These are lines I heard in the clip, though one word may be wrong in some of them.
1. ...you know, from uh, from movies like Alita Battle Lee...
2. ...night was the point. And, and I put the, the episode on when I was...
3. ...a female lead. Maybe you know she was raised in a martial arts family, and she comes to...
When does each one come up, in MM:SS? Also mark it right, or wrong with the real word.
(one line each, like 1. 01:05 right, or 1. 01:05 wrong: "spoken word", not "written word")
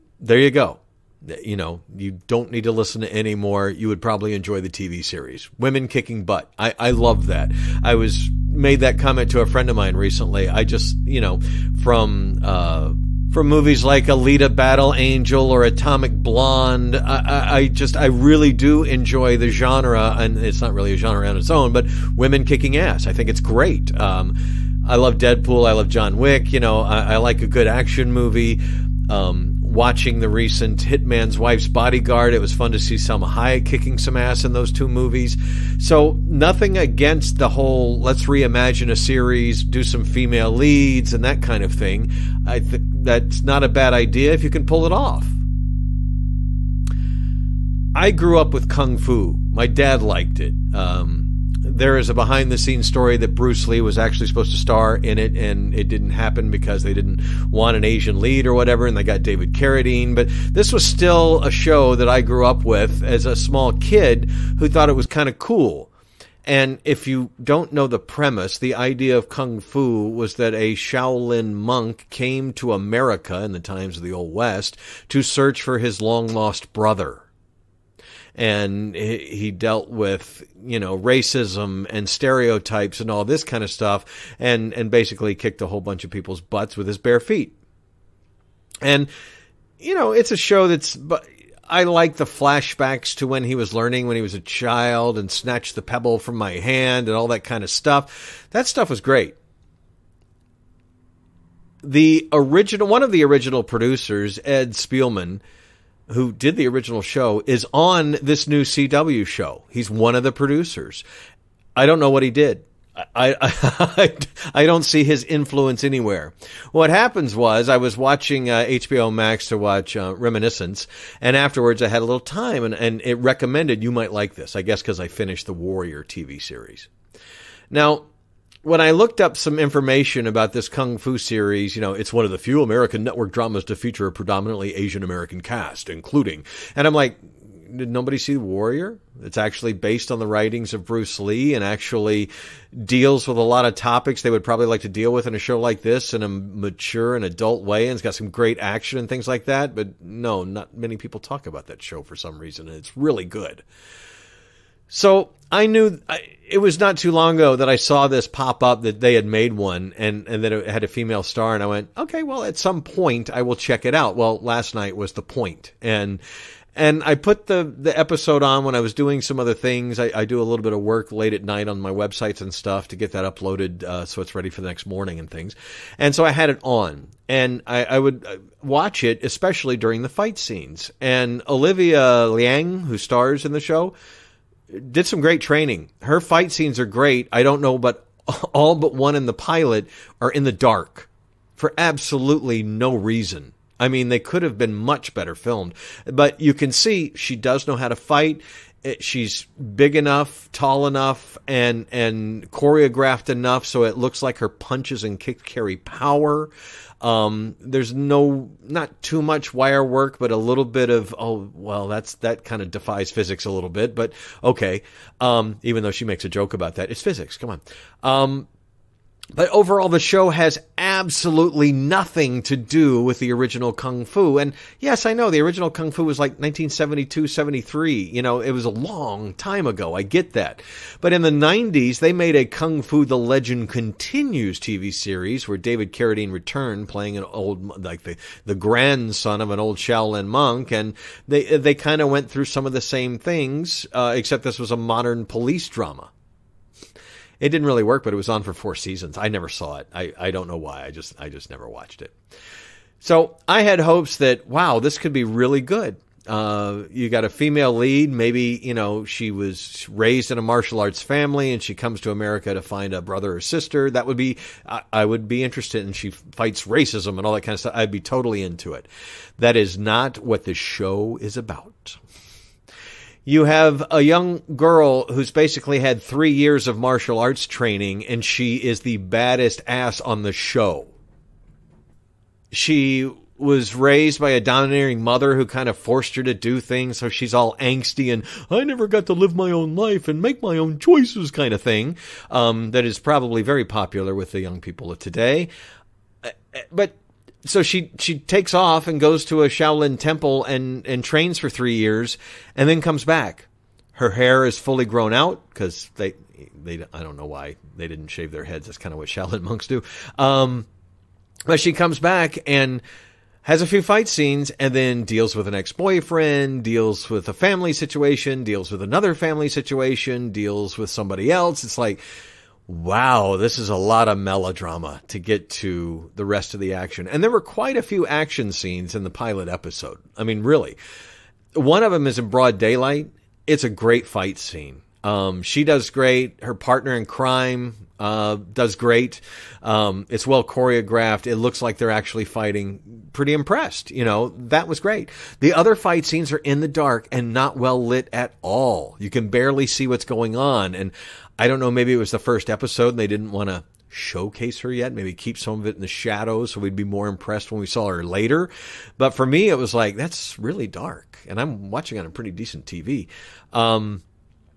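1. 00:11 wrong: "Angel", not "Lee"
2. 02:44 right
3. 04:17 right.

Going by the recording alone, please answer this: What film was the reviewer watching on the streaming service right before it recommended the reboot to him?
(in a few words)
Reminiscence.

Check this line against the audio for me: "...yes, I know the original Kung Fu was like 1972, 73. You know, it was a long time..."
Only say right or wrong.
right.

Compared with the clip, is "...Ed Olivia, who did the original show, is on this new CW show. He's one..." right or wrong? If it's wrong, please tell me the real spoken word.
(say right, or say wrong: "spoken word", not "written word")
wrong: "Spielman", not "Olivia".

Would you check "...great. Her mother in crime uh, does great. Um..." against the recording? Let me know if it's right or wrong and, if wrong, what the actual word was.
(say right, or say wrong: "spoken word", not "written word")
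wrong: "partner", not "mother".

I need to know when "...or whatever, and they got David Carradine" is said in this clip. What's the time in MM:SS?
00:58.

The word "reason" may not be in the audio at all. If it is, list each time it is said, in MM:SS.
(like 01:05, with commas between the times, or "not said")
02:32, 03:12.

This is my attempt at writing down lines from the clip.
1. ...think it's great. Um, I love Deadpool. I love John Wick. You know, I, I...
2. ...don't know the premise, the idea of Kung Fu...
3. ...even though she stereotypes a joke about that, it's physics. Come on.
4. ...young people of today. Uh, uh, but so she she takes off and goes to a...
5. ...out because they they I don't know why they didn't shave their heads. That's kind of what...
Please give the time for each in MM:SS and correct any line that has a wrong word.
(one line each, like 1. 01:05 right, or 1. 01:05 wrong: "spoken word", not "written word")
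1. 00:23 right
2. 01:07 right
3. 03:35 wrong: "makes", not "stereotypes"
4. 04:54 right
5. 05:05 right.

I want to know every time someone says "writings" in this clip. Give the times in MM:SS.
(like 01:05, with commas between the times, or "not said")
02:20.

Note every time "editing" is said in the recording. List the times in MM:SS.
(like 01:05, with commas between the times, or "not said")
not said.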